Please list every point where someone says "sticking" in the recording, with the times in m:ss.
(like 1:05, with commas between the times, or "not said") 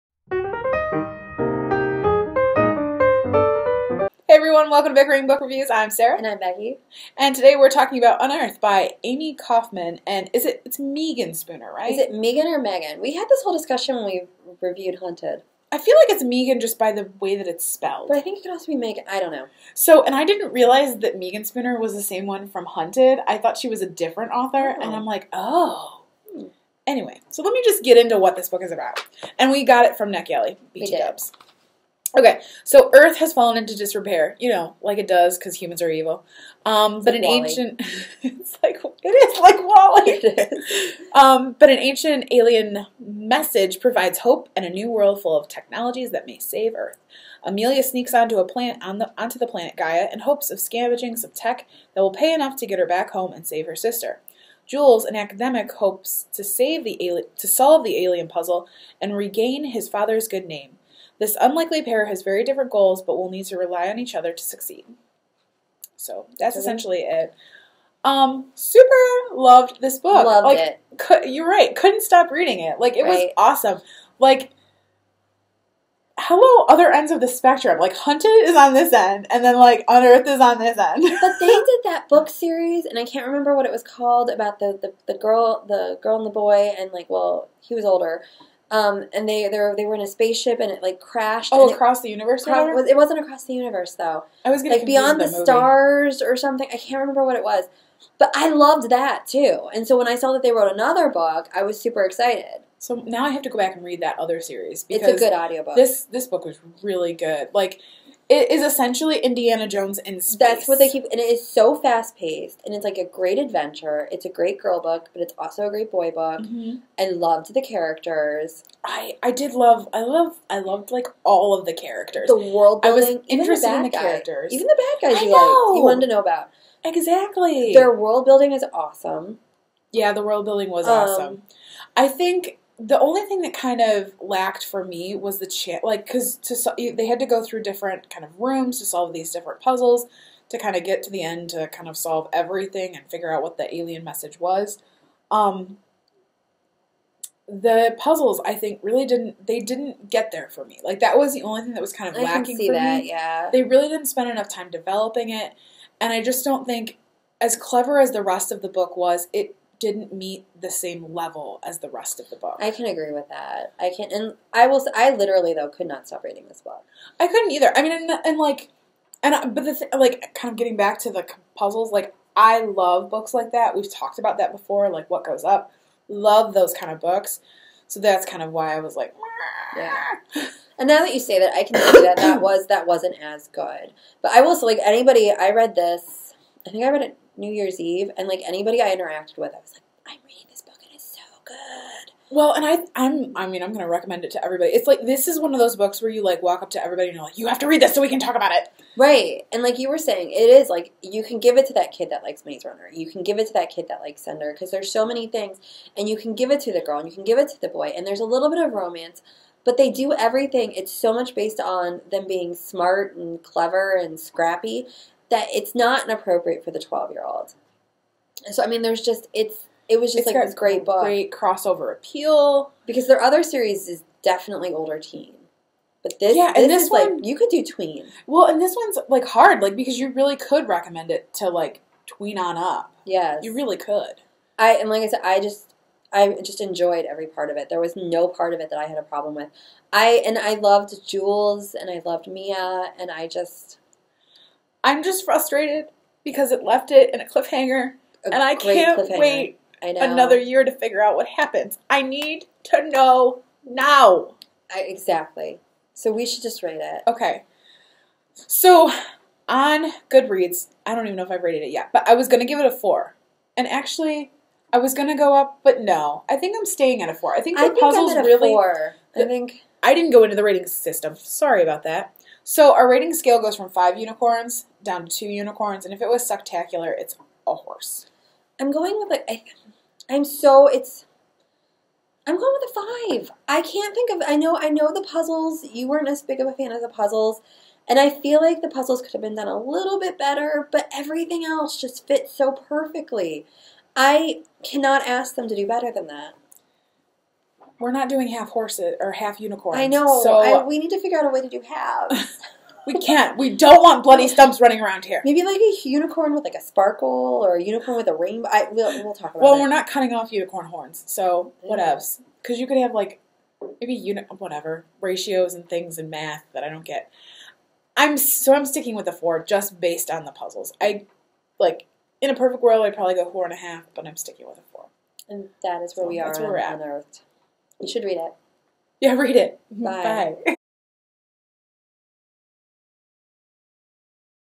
5:18, 5:24.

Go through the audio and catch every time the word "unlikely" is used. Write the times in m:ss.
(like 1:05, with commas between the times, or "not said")
1:01.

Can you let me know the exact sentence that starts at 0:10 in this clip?
And is it, it's Meagan Spooner, right?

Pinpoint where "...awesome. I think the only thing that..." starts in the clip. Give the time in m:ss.
2:10.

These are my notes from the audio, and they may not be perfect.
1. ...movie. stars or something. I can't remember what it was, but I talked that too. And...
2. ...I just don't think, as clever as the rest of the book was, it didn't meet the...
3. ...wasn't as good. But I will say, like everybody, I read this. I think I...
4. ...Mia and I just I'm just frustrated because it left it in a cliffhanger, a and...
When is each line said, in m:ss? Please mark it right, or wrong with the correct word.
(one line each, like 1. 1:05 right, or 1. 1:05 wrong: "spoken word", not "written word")
1. 1:35 wrong: "loved", not "talked"
2. 2:36 right
3. 3:02 wrong: "anybody", not "everybody"
4. 4:02 right.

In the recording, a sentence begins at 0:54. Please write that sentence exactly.
Jules, an academic, hopes to save the to solve the alien puzzle and regain his father's good name.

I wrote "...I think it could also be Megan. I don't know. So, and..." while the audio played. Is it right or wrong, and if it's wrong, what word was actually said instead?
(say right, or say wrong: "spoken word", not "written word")
right.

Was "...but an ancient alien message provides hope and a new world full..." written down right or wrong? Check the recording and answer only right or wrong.
right.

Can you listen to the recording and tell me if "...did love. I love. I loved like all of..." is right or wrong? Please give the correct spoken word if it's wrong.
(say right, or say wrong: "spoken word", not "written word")
right.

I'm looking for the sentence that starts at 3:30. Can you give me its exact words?
It's so much based on them being smart and clever and scrappy that it's not inappropriate for the 12 year old.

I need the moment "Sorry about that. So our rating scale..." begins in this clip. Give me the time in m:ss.
4:31.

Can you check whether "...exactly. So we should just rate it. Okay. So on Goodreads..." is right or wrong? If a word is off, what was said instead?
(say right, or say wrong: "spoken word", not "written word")
right.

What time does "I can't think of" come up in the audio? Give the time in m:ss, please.
4:43.